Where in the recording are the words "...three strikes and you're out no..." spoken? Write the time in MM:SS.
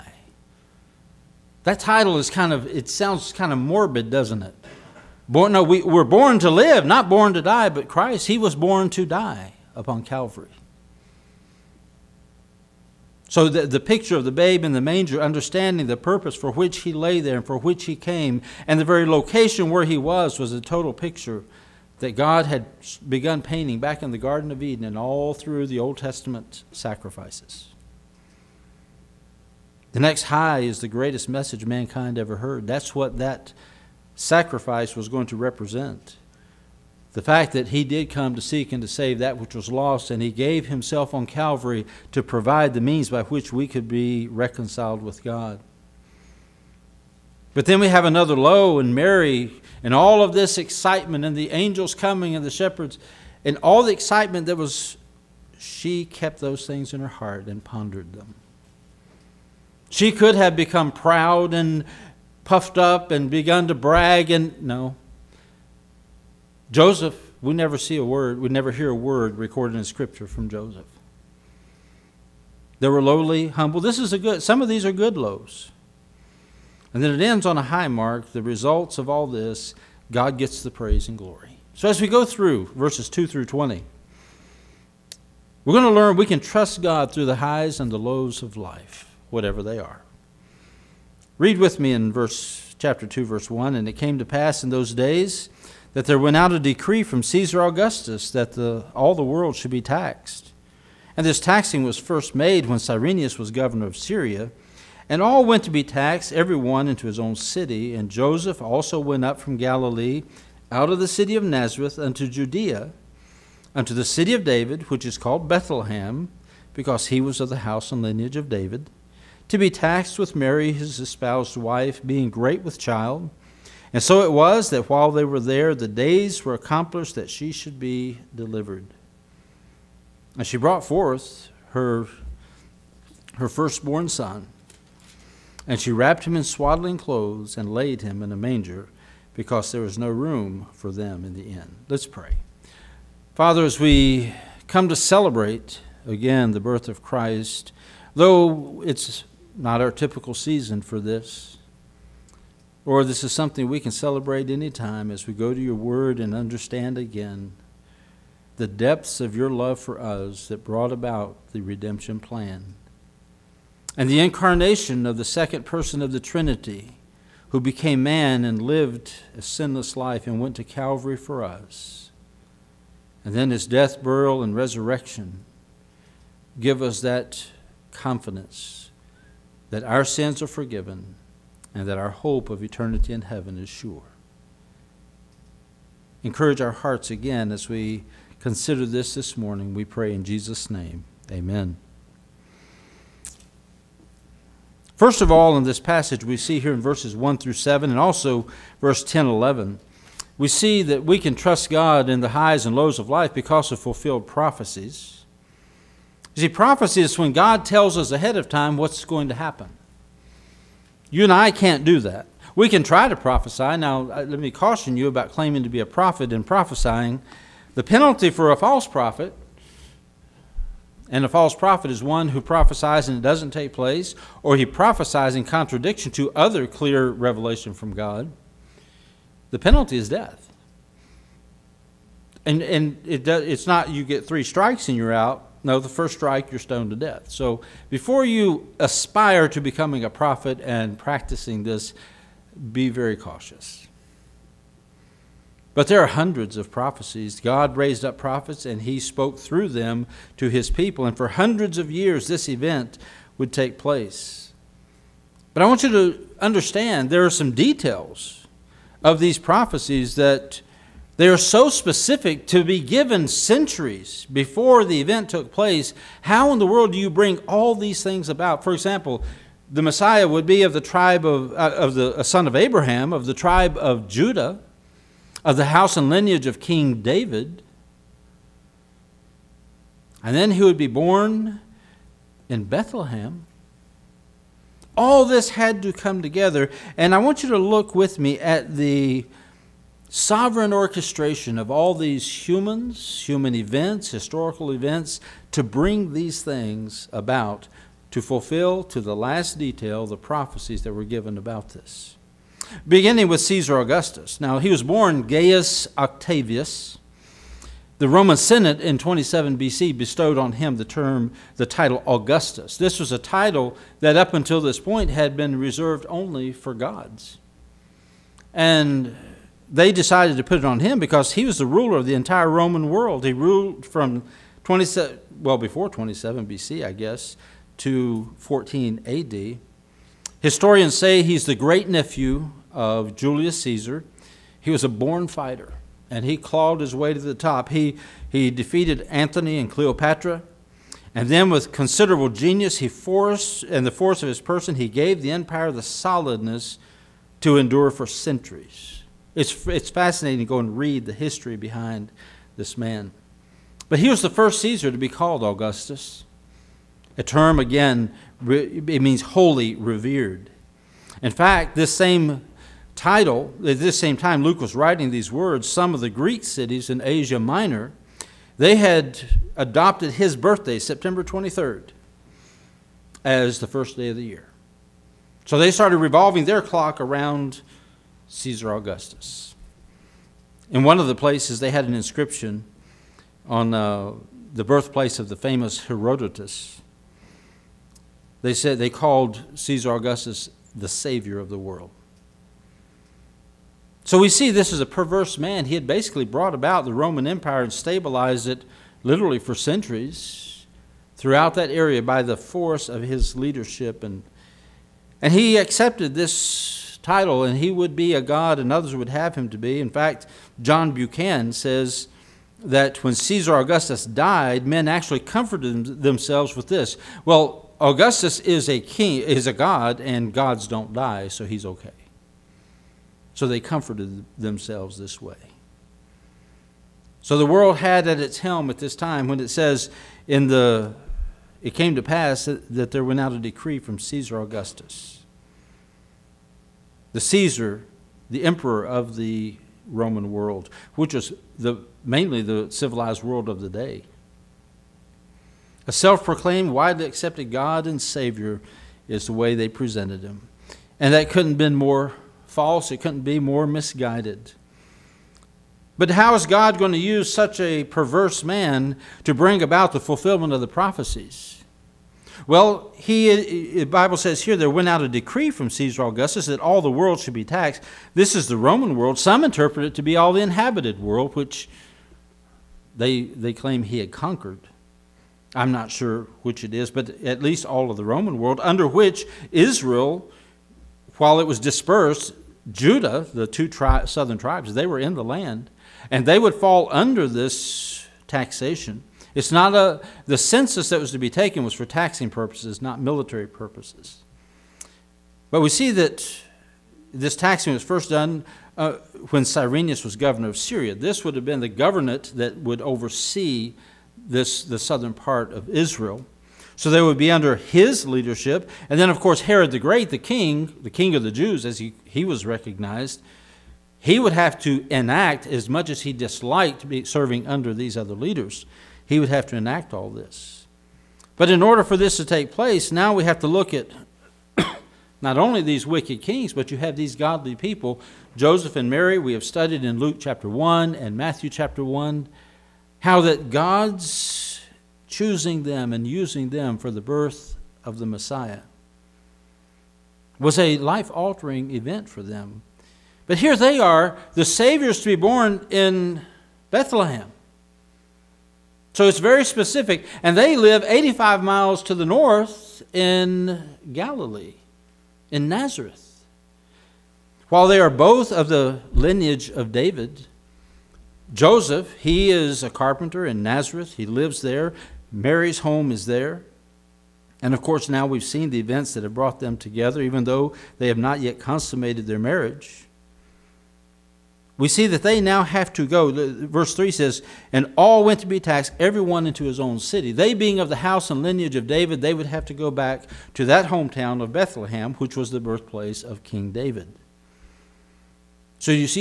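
03:54.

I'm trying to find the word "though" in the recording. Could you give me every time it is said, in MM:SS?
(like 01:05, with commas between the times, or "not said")
02:28, 09:30.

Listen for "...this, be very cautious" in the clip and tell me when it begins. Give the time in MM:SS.
04:01.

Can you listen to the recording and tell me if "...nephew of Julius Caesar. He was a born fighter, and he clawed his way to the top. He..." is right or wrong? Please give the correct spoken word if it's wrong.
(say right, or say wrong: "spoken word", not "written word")
right.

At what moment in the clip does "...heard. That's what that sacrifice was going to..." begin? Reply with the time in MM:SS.
00:32.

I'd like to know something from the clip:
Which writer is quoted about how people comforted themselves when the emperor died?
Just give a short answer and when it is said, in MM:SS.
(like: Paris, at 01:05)
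John Buchan, at 06:50.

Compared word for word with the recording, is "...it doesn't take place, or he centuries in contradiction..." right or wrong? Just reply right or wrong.
wrong.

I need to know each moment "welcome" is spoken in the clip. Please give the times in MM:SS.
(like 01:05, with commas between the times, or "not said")
not said.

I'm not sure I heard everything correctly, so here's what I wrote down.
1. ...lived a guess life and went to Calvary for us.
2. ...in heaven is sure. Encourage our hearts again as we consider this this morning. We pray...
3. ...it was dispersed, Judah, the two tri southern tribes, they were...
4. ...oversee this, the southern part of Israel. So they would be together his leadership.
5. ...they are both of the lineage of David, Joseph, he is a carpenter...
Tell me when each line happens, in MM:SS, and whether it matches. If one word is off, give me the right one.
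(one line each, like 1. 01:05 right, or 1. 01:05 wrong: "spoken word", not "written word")
1. 02:48 wrong: "sinless", not "guess"
2. 03:03 right
3. 08:01 right
4. 08:22 wrong: "under", not "together"
5. 09:17 right.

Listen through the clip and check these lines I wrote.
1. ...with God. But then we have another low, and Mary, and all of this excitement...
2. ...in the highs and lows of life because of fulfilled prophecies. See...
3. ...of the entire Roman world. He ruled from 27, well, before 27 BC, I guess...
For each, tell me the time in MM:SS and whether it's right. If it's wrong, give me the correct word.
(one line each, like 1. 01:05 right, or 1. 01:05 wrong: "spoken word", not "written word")
1. 00:45 right
2. 03:22 right
3. 05:21 right.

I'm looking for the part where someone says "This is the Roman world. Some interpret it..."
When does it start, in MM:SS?
07:48.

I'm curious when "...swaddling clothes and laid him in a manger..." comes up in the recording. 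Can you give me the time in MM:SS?
02:16.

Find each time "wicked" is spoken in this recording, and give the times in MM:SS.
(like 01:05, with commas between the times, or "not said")
08:45.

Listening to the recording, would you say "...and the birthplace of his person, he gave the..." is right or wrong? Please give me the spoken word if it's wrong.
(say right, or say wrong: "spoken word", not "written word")
wrong: "force", not "birthplace".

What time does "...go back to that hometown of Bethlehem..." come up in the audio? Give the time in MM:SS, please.
09:42.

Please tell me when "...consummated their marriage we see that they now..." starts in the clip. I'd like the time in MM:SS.
09:31.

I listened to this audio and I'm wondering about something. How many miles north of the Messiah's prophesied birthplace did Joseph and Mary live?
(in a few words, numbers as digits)
85 miles.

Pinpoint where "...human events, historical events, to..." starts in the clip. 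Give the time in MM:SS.
04:53.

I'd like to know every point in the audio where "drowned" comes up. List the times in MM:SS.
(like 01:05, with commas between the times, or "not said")
not said.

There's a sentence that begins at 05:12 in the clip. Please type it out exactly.
This was a title that up until this point had been reserved only for gods.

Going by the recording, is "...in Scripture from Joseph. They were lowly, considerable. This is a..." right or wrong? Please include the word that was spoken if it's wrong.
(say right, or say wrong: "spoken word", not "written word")
wrong: "humble", not "considerable".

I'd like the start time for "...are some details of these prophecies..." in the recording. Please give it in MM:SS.
04:17.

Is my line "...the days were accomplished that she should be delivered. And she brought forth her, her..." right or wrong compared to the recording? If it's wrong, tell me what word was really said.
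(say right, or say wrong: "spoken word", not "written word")
right.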